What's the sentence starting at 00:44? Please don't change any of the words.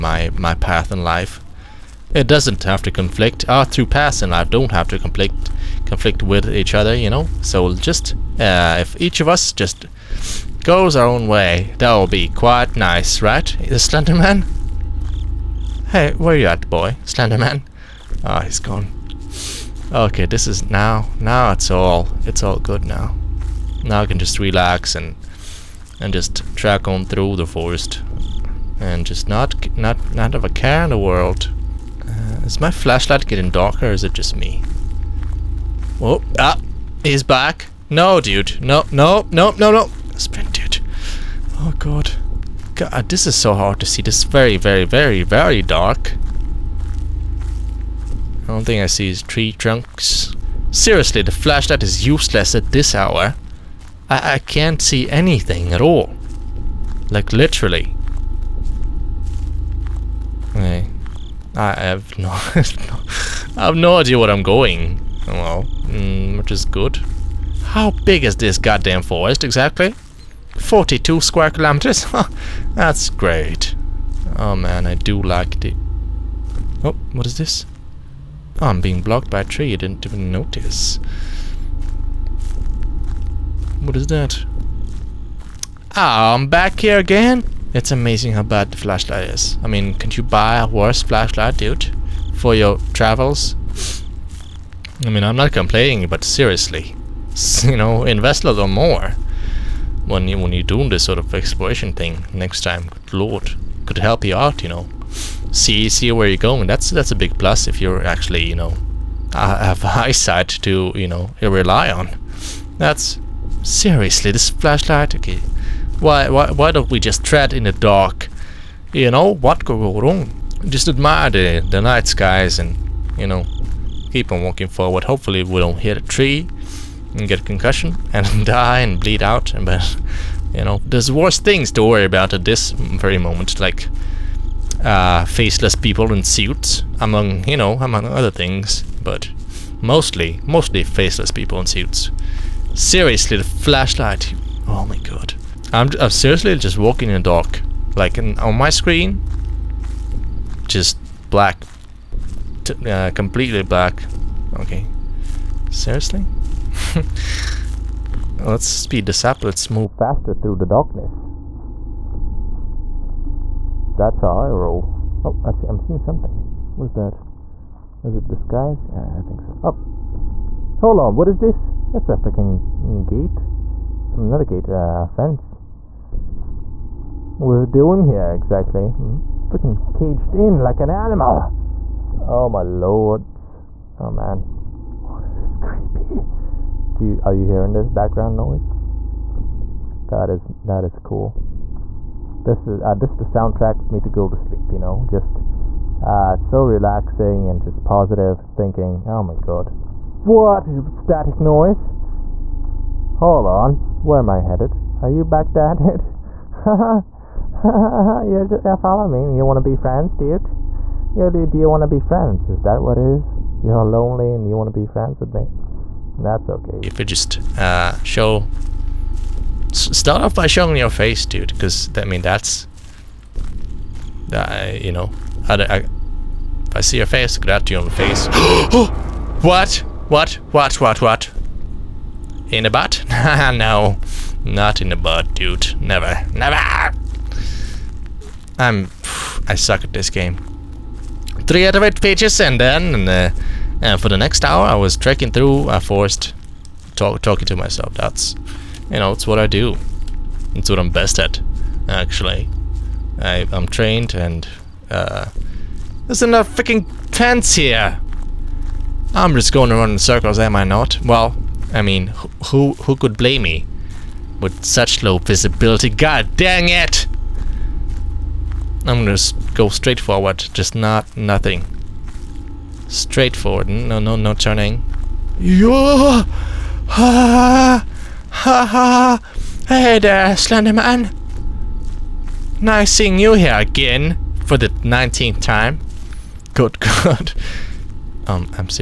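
This is very, very, very, very dark.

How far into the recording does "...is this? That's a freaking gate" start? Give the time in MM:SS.
02:51.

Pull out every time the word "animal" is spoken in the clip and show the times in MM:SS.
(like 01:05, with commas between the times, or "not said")
03:00.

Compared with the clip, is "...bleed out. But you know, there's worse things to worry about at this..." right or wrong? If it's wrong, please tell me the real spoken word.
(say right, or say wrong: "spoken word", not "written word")
right.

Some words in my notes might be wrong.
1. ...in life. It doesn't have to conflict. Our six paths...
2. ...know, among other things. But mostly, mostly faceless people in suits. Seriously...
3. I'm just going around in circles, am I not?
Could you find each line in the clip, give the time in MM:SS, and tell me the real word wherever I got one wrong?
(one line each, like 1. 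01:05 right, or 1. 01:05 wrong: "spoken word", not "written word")
1. 00:00 wrong: "two", not "six"
2. 02:17 right
3. 04:19 right.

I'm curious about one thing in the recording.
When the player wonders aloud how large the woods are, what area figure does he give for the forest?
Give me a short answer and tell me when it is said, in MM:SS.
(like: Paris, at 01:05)
42 square kilometers, at 01:10.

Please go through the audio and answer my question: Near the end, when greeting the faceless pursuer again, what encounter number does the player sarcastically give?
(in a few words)
19th.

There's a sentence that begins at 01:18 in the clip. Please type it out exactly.
Oh, I'm being blocked by a tree, I didn't even notice.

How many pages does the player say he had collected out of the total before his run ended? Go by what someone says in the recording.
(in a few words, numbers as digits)
3 out of 8.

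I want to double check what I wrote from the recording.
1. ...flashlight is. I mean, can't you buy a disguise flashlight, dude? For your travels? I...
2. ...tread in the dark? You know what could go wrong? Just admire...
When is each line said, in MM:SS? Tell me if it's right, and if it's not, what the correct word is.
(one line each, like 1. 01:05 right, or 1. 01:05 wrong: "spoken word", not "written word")
1. 01:28 wrong: "worse", not "disguise"
2. 01:57 right.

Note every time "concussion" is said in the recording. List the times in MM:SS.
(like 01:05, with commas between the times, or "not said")
02:07.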